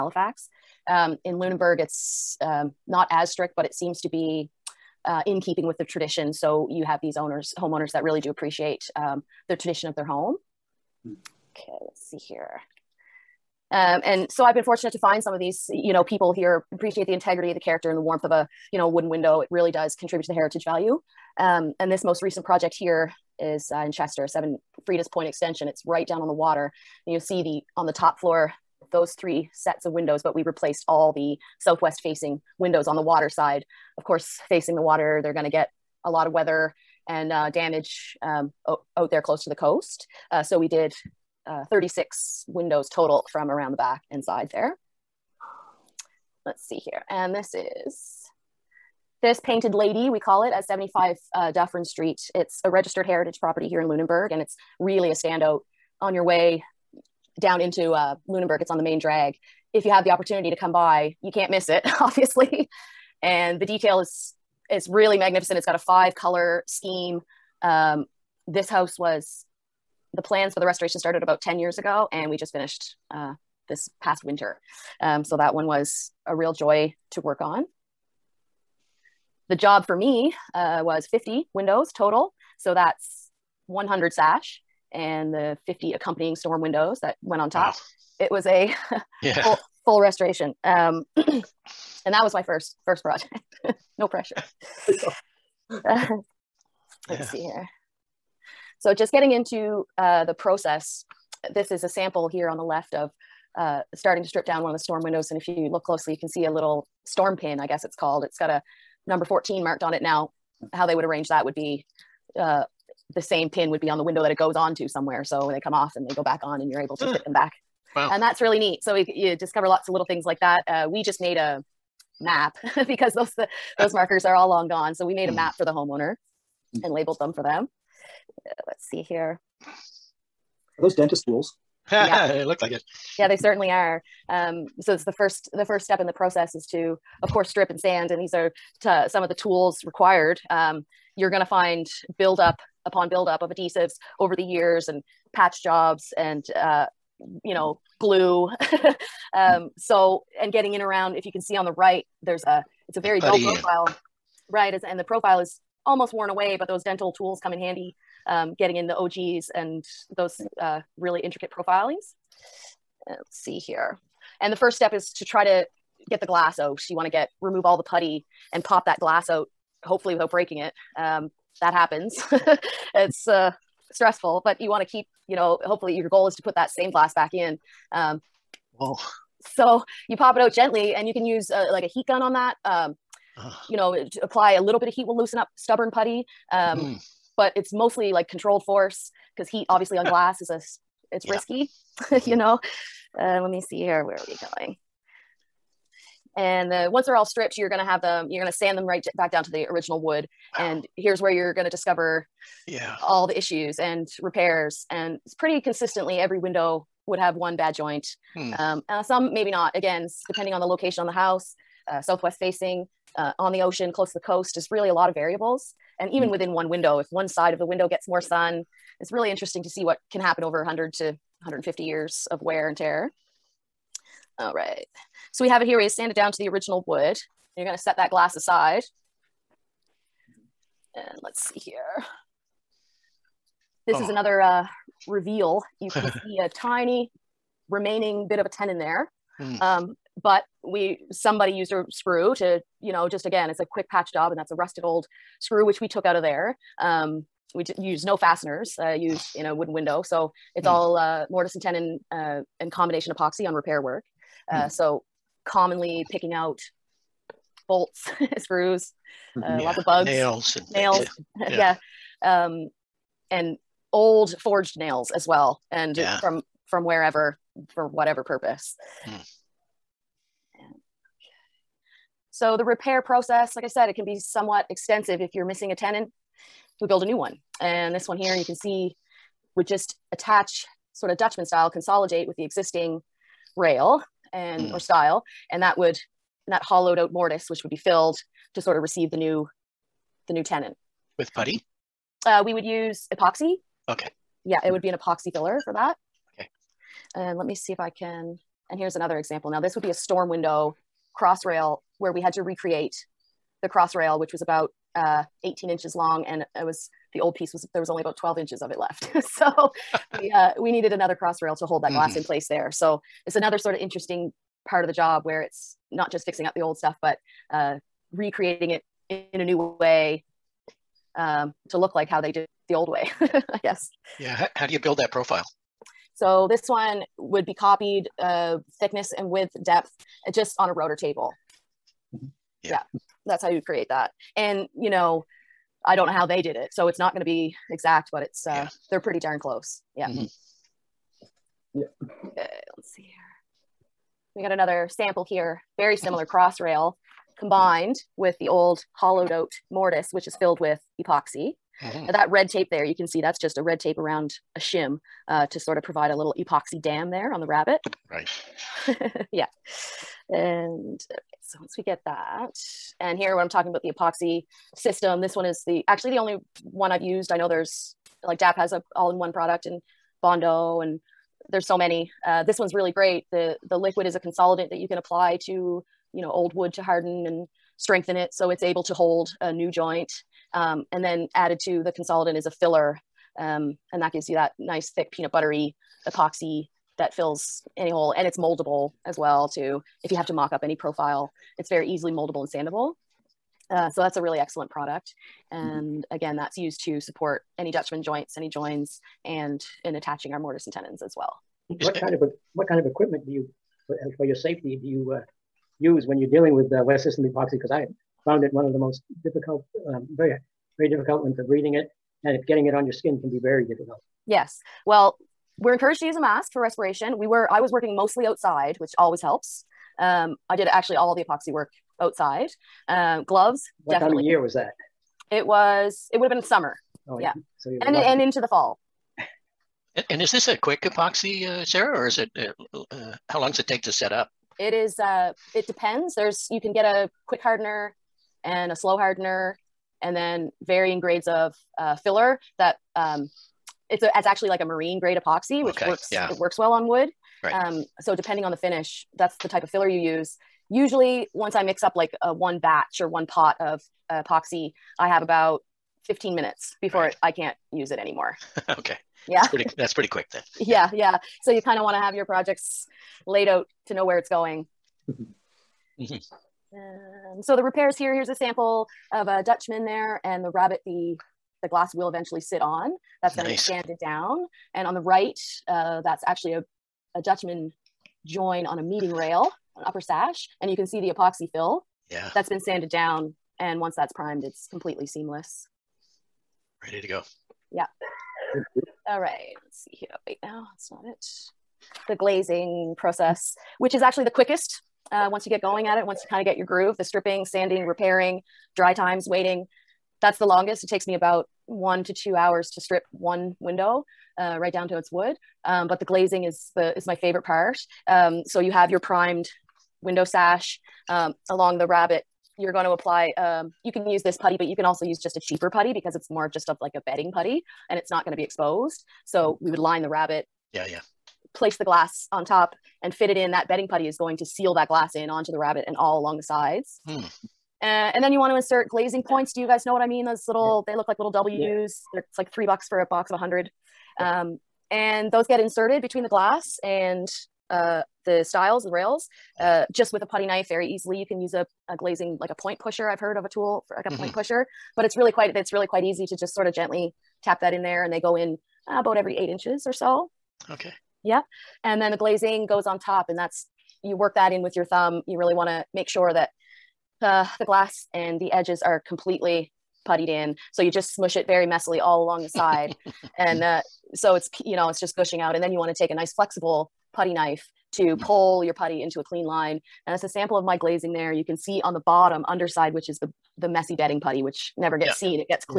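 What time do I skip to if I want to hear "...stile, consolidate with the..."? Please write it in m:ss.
4:41.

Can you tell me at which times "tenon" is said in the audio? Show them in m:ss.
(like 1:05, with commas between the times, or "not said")
3:58, 4:11, 4:35, 4:50, 6:40.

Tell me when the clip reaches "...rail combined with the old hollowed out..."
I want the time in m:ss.
5:46.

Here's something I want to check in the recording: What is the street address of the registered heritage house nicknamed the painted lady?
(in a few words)
75 Dufferin Street.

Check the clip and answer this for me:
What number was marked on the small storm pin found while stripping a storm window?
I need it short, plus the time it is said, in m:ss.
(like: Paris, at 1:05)
14, at 1:49.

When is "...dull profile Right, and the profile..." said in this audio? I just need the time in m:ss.
2:33.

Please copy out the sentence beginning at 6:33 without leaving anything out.
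Uh, so that's a really excellent product.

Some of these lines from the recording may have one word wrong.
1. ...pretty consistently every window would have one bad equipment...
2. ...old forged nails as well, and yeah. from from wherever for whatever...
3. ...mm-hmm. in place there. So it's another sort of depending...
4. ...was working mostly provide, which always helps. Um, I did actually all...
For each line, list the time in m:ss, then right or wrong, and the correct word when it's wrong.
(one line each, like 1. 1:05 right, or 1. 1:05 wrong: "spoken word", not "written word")
1. 3:25 wrong: "joint", not "equipment"
2. 4:23 right
3. 5:12 wrong: "interesting", not "depending"
4. 6:57 wrong: "outside", not "provide".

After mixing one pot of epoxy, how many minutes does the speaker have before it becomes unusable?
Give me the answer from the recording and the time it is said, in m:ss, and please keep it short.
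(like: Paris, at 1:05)
15, at 7:36.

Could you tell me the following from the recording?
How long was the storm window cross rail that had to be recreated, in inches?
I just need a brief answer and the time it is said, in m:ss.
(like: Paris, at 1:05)
18 inches, at 5:05.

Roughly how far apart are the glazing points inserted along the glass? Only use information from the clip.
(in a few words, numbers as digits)
8 inches.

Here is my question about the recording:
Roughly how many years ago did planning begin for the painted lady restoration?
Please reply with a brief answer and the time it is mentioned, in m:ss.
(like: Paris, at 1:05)
10, at 1:11.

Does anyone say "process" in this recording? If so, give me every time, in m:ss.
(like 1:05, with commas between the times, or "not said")
1:40, 2:16, 4:33, 8:12.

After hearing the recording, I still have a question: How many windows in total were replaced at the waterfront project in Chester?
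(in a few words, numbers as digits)
36.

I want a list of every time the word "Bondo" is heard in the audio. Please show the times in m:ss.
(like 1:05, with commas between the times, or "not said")
6:10.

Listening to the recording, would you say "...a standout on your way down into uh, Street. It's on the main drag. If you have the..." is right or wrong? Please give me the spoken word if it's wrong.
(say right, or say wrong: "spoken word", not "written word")
wrong: "Lunenburg", not "Street".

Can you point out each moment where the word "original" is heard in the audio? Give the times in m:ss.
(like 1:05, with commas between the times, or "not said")
3:19, 3:46.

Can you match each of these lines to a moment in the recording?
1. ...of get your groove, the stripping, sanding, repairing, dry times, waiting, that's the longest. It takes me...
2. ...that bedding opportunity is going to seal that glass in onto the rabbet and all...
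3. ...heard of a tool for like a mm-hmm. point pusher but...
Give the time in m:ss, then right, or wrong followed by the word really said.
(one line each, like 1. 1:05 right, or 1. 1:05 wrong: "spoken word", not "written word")
1. 8:16 right
2. 8:43 wrong: "putty", not "opportunity"
3. 9:03 right.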